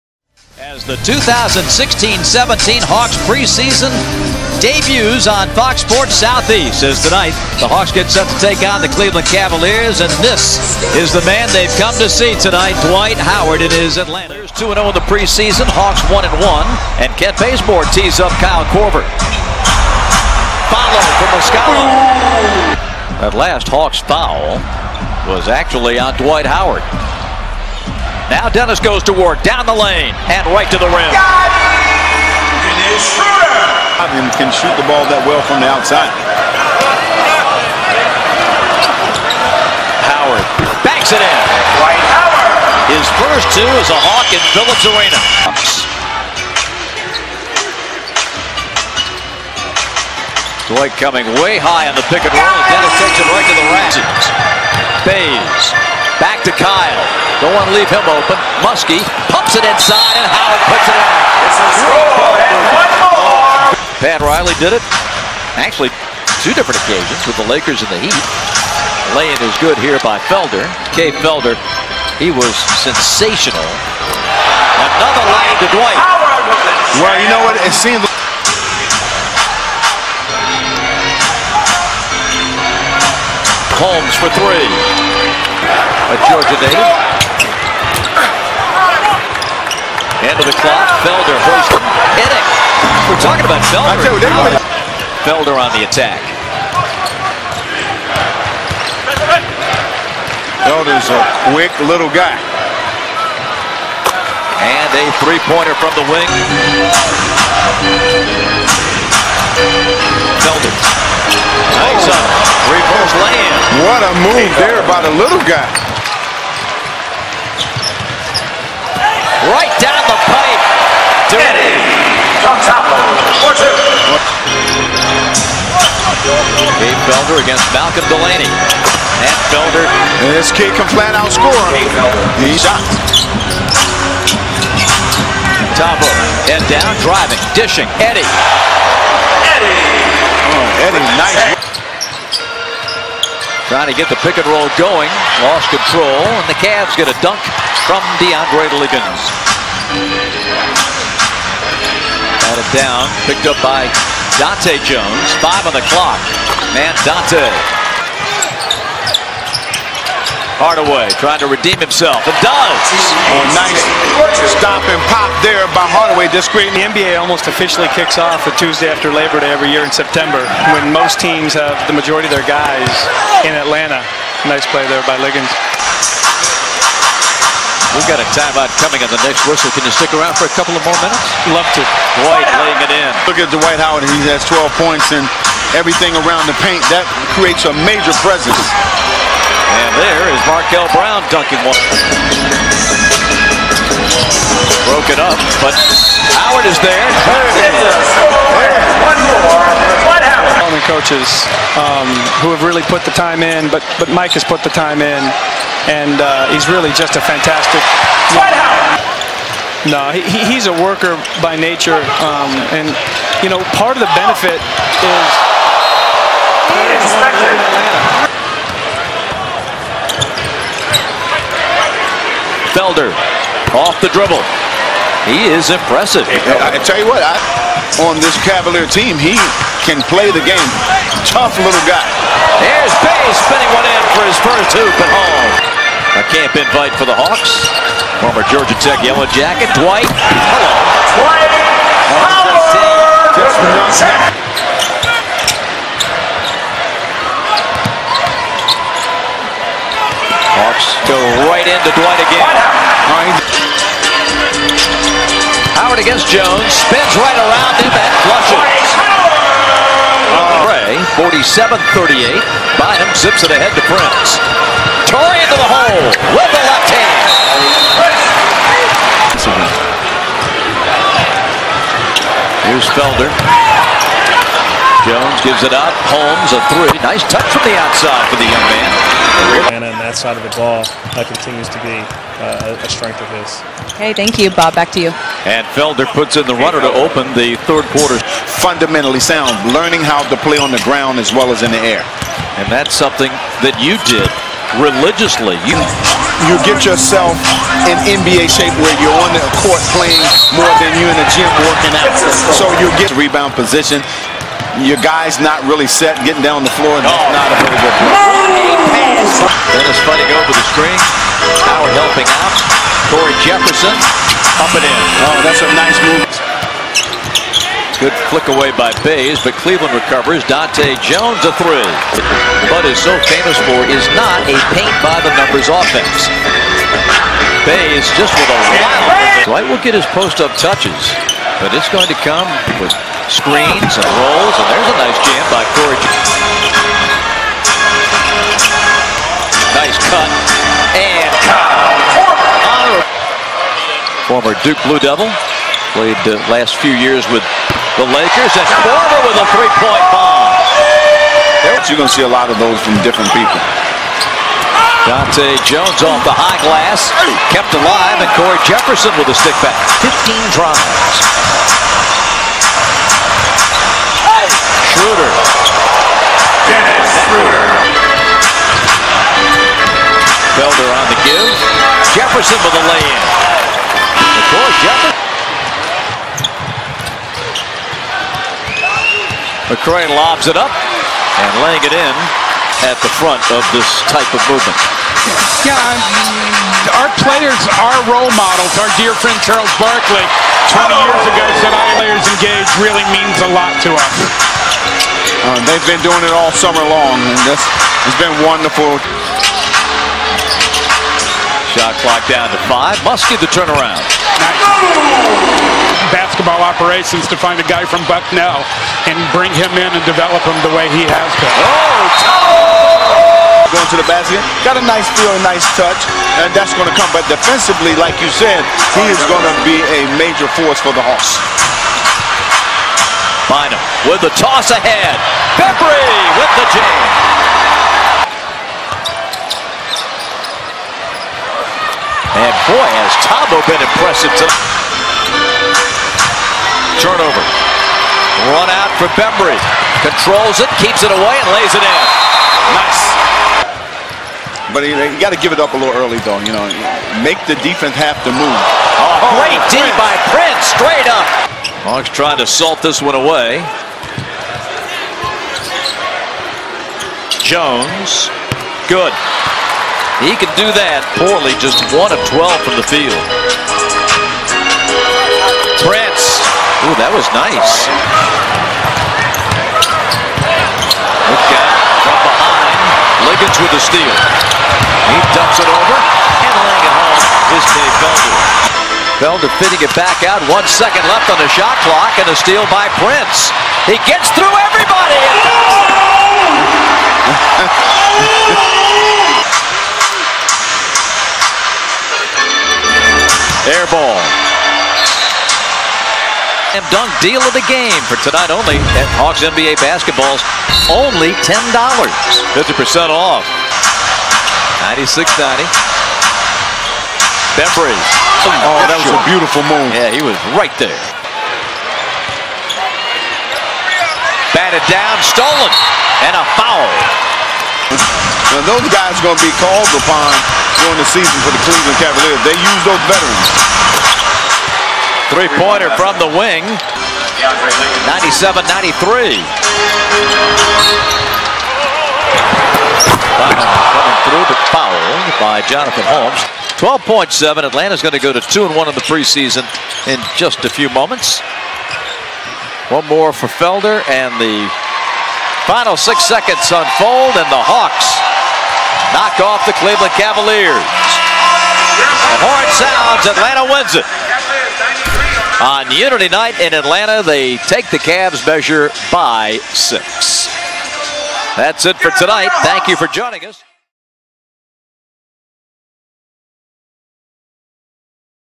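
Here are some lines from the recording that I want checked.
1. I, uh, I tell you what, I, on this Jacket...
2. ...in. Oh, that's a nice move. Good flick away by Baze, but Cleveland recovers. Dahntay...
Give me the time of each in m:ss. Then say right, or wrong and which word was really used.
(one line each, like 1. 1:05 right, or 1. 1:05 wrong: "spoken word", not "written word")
1. 3:46 wrong: "Cavalier", not "Jacket"
2. 5:14 right.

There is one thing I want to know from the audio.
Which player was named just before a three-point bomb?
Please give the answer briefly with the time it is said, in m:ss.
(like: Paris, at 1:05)
Schwarber, at 5:48.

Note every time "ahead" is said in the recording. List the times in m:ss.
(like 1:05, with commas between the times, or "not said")
4:23, 7:04.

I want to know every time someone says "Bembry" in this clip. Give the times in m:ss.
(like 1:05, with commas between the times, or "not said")
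7:19, 8:27.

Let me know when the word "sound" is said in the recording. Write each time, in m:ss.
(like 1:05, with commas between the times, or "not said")
4:49, 9:12.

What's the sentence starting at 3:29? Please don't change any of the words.
No, he, he's a worker by nature, um, and you know part of the benefit is.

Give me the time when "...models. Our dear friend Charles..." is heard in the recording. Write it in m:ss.
6:28.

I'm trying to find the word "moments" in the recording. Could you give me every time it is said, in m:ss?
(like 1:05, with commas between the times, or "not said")
9:00.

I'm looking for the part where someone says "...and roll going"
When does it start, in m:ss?
2:24.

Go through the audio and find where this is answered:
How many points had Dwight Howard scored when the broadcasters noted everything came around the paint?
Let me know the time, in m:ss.
3:04.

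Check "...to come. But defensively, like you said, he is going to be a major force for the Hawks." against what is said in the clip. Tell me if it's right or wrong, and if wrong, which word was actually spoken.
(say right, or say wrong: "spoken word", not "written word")
right.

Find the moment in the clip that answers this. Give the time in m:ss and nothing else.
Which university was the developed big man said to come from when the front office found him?
6:48.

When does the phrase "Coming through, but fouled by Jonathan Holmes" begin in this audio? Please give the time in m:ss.
8:53.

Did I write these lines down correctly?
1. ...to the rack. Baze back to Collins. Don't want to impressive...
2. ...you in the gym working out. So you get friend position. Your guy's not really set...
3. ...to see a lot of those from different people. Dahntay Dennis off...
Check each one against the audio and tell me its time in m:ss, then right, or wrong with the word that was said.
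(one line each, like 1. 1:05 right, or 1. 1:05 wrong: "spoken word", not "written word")
1. 0:53 wrong: "leave", not "impressive"
2. 5:01 wrong: "rebound", not "friend"
3. 5:52 wrong: "Jones", not "Dennis".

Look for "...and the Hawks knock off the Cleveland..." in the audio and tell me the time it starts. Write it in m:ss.
9:07.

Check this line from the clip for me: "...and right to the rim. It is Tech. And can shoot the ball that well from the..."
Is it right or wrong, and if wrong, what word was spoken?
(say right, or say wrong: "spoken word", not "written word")
wrong: "Schroeder", not "Tech".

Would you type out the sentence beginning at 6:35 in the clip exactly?
Uh, they've been doing it all summer long, and this has been wonderful.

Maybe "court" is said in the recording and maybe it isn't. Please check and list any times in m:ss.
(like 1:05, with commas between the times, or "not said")
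4:59.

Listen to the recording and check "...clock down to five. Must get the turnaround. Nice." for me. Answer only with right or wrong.
right.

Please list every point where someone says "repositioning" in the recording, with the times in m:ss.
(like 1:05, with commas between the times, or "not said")
not said.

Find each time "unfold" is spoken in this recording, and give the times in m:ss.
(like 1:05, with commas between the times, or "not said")
9:06.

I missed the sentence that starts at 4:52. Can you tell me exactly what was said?
And that's something that you did religiously.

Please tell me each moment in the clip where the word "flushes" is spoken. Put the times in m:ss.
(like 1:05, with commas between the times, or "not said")
4:18.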